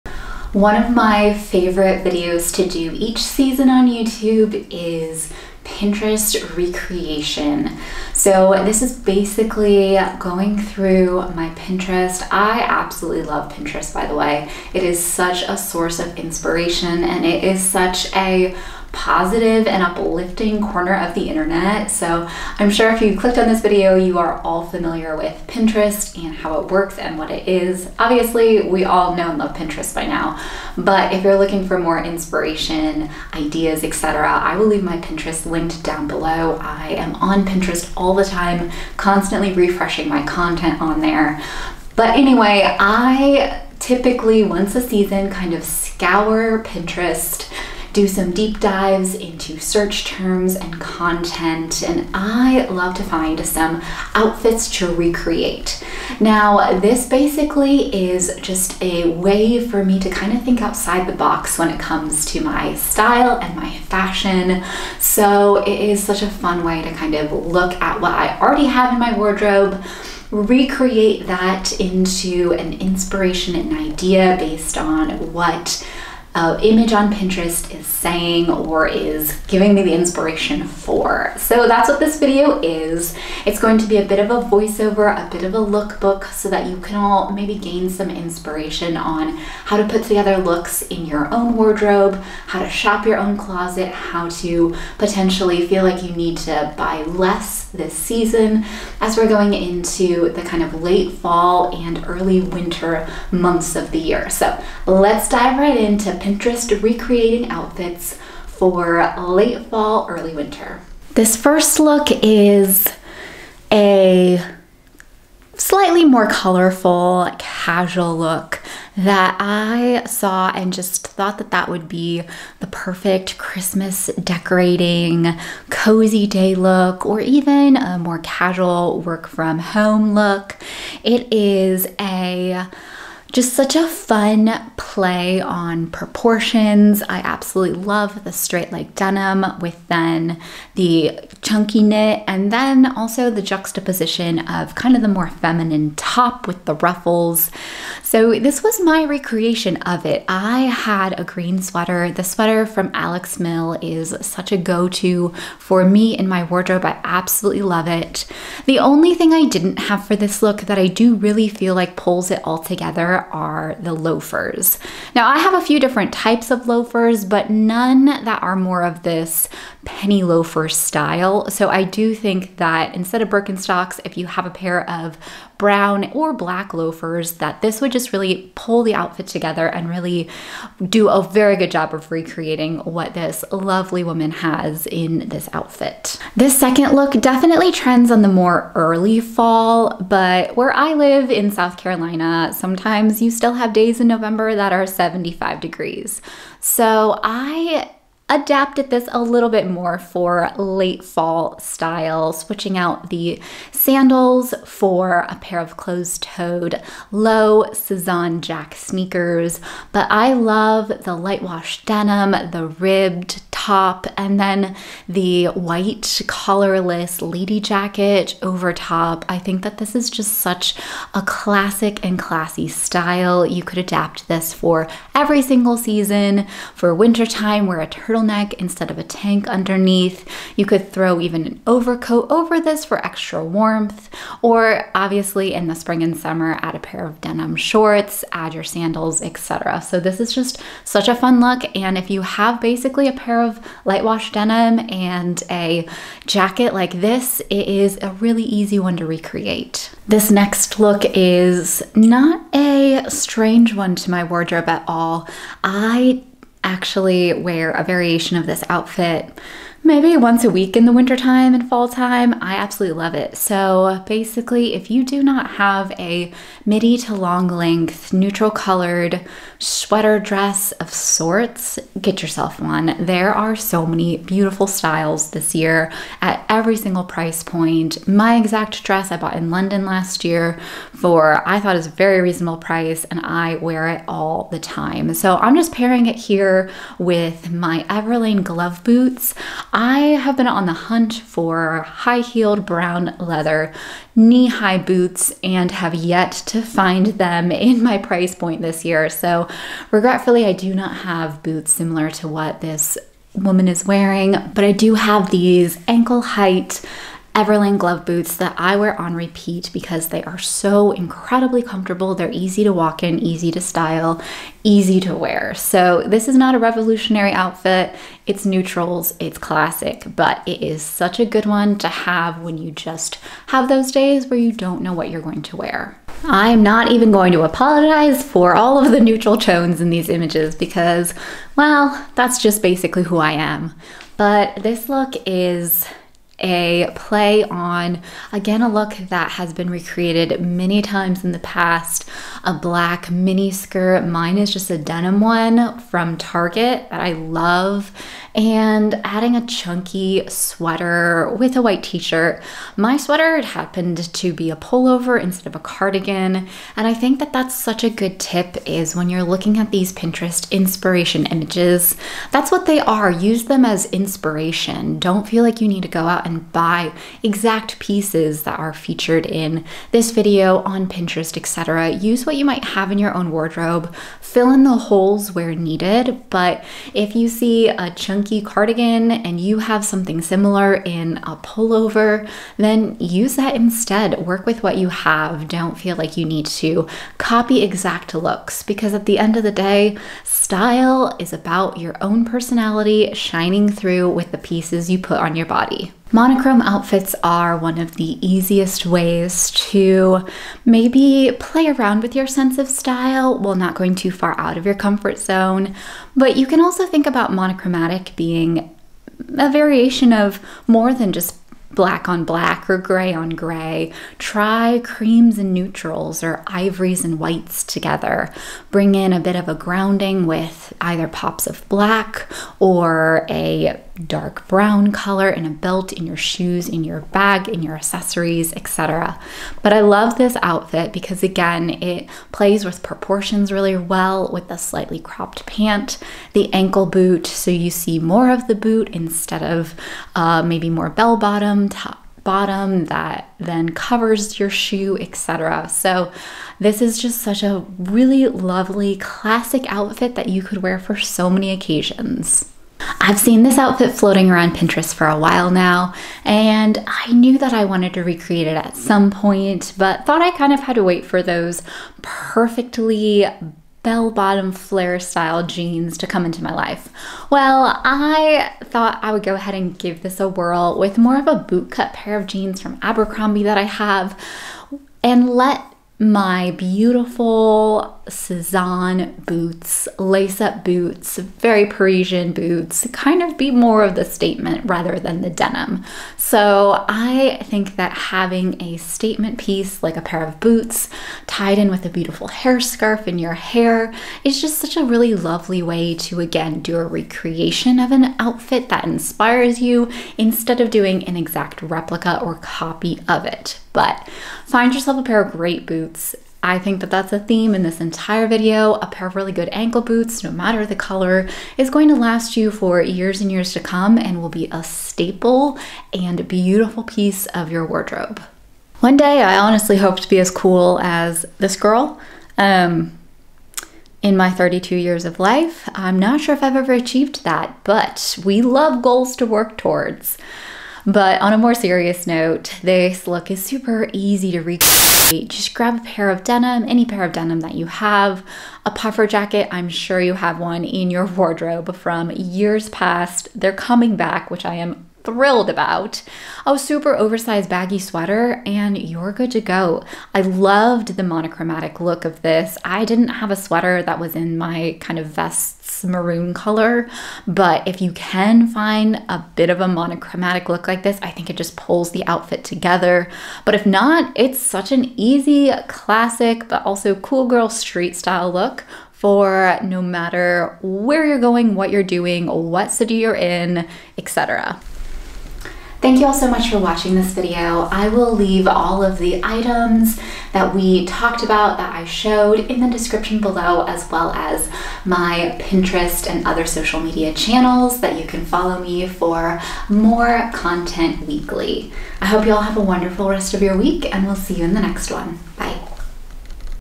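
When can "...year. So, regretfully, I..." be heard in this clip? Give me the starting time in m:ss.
4:58.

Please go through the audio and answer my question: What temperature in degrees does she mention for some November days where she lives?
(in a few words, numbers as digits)
75.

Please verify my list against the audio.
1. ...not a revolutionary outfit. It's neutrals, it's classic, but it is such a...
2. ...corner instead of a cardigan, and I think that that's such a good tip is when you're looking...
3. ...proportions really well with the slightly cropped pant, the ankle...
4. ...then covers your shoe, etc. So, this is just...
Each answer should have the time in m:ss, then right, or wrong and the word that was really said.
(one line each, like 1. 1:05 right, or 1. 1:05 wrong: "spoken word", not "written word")
1. 5:16 right
2. 5:54 wrong: "pullover", not "corner"
3. 7:12 right
4. 7:23 right.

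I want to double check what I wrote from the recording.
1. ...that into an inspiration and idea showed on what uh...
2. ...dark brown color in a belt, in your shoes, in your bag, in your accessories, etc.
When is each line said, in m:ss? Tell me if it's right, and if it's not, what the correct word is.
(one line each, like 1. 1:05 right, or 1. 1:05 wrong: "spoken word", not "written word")
1. 1:11 wrong: "based", not "showed"
2. 7:04 right.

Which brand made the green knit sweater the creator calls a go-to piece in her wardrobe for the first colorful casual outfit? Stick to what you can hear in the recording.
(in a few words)
Alex Mill.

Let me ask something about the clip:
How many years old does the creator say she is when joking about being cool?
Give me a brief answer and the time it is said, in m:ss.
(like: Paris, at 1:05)
32, at 8:44.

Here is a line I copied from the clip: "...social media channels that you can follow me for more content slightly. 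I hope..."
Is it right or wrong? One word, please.
wrong.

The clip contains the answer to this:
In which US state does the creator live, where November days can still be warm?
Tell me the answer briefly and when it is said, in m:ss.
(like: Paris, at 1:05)
South Carolina, at 3:11.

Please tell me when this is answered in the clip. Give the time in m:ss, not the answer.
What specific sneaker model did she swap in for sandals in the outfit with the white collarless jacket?
3:27.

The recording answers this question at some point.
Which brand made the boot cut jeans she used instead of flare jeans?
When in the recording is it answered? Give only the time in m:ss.
7:52.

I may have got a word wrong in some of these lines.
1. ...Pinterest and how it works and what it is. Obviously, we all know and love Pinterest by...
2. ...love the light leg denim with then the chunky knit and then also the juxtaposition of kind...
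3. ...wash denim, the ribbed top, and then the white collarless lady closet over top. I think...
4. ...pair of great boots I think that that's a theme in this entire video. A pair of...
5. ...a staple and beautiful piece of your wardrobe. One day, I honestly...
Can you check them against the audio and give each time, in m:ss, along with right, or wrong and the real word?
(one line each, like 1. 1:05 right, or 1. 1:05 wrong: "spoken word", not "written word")
1. 0:25 right
2. 2:17 wrong: "straight", not "light"
3. 3:31 wrong: "jacket", not "closet"
4. 8:25 right
5. 8:34 right.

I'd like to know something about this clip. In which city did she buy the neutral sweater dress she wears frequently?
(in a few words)
London.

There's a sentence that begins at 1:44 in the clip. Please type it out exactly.
So let's dive right into Pinterest recreating outfits for late fall, early winter.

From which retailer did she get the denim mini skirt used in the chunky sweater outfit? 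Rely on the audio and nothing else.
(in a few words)
Target.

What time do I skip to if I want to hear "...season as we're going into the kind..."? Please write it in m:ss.
1:37.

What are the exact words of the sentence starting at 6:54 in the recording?
Try creams and neutrals or ivories and whites together.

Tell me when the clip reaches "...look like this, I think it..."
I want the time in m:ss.
9:20.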